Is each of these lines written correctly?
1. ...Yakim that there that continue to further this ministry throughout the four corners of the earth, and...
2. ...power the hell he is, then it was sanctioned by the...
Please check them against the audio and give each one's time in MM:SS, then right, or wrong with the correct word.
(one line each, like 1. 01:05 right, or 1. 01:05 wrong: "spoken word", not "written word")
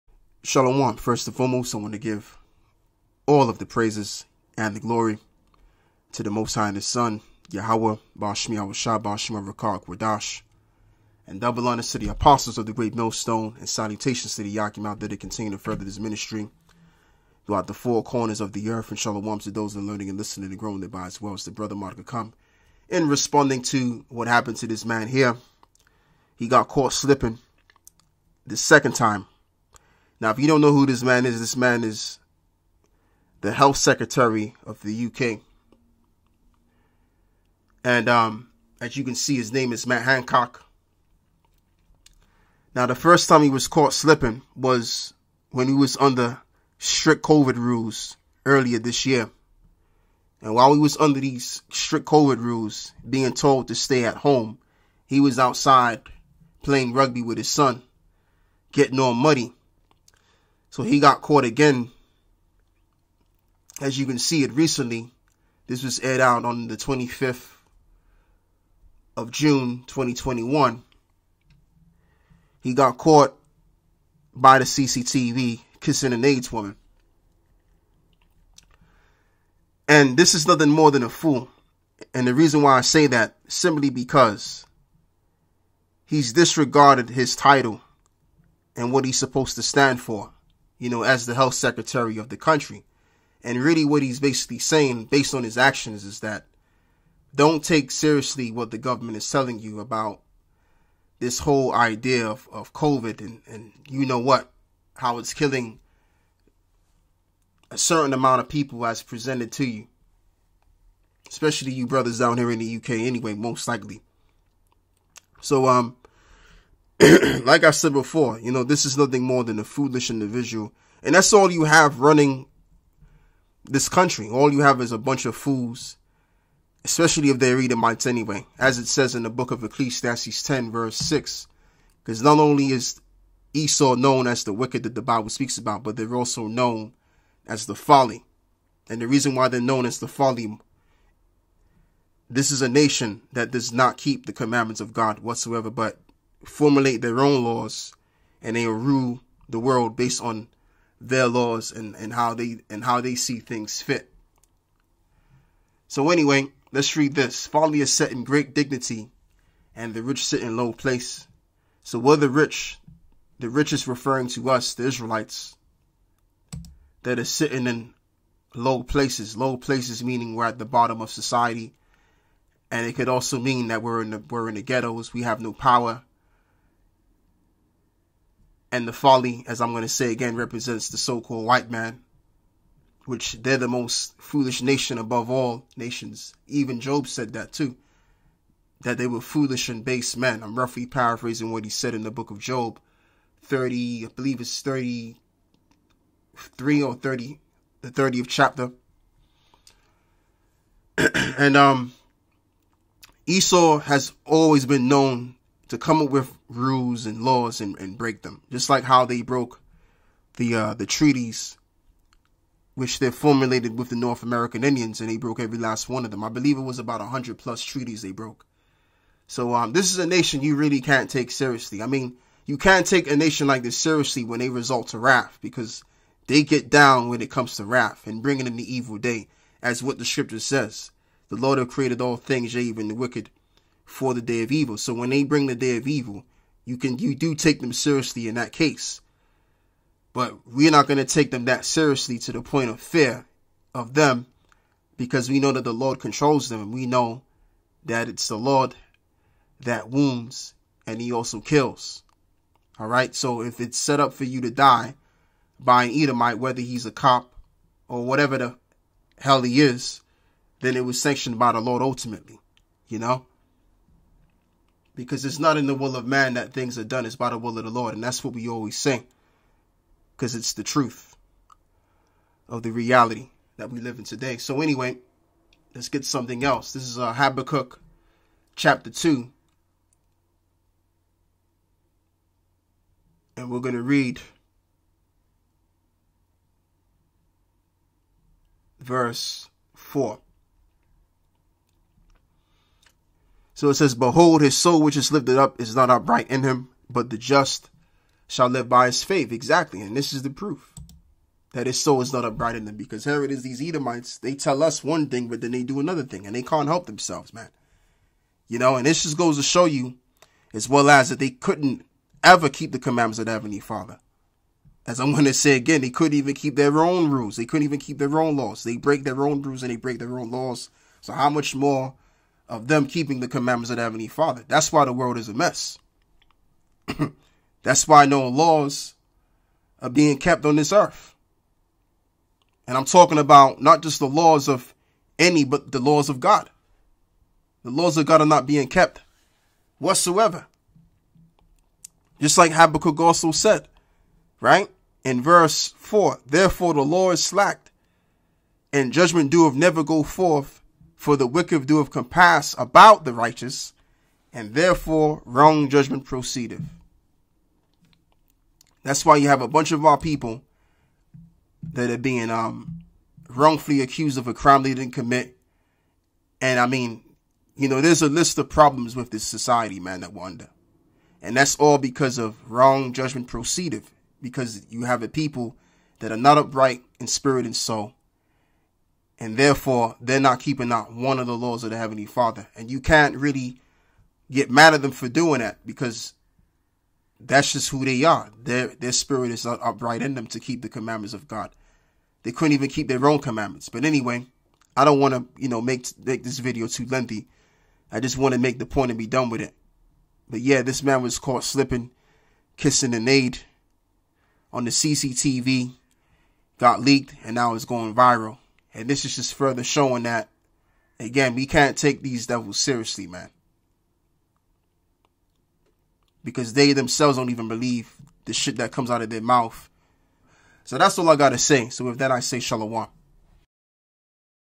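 1. 00:14 right
2. 04:18 wrong: "whatever", not "power".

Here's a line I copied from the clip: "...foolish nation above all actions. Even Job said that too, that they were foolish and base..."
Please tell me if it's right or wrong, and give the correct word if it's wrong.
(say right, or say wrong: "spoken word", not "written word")
wrong: "nations", not "actions".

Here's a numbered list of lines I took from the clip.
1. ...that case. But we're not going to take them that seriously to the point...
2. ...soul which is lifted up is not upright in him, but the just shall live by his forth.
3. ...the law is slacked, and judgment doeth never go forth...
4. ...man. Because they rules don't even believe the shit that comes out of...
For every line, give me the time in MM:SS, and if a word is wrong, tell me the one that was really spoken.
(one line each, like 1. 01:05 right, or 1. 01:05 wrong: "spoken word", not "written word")
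1. 03:58 right
2. 04:54 wrong: "faith", not "forth"
3. 05:46 right
4. 06:53 wrong: "themselves", not "rules".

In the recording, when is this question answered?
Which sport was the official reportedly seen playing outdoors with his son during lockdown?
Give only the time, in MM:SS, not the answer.
00:56.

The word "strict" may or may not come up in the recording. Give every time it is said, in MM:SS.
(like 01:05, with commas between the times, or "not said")
00:46, 00:51.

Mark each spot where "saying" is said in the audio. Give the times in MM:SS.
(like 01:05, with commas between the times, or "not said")
01:34.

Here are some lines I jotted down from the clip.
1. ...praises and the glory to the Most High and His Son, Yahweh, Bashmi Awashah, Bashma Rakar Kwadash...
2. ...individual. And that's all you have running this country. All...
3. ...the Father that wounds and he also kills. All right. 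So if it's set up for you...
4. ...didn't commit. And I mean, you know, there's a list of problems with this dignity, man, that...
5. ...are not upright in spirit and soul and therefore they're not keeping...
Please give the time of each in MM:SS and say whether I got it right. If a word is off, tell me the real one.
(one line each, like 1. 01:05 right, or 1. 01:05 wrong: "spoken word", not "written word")
1. 00:03 right
2. 02:00 right
3. 04:08 wrong: "Lord", not "Father"
4. 06:04 wrong: "society", not "dignity"
5. 06:16 right.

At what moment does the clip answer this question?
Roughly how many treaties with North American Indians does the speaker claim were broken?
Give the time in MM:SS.
03:37.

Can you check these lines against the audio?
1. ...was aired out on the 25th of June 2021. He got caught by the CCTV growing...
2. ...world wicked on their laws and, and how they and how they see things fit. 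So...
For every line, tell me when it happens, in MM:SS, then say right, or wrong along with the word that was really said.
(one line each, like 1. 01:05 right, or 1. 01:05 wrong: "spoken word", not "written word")
1. 01:05 wrong: "kissing", not "growing"
2. 02:29 wrong: "based", not "wicked".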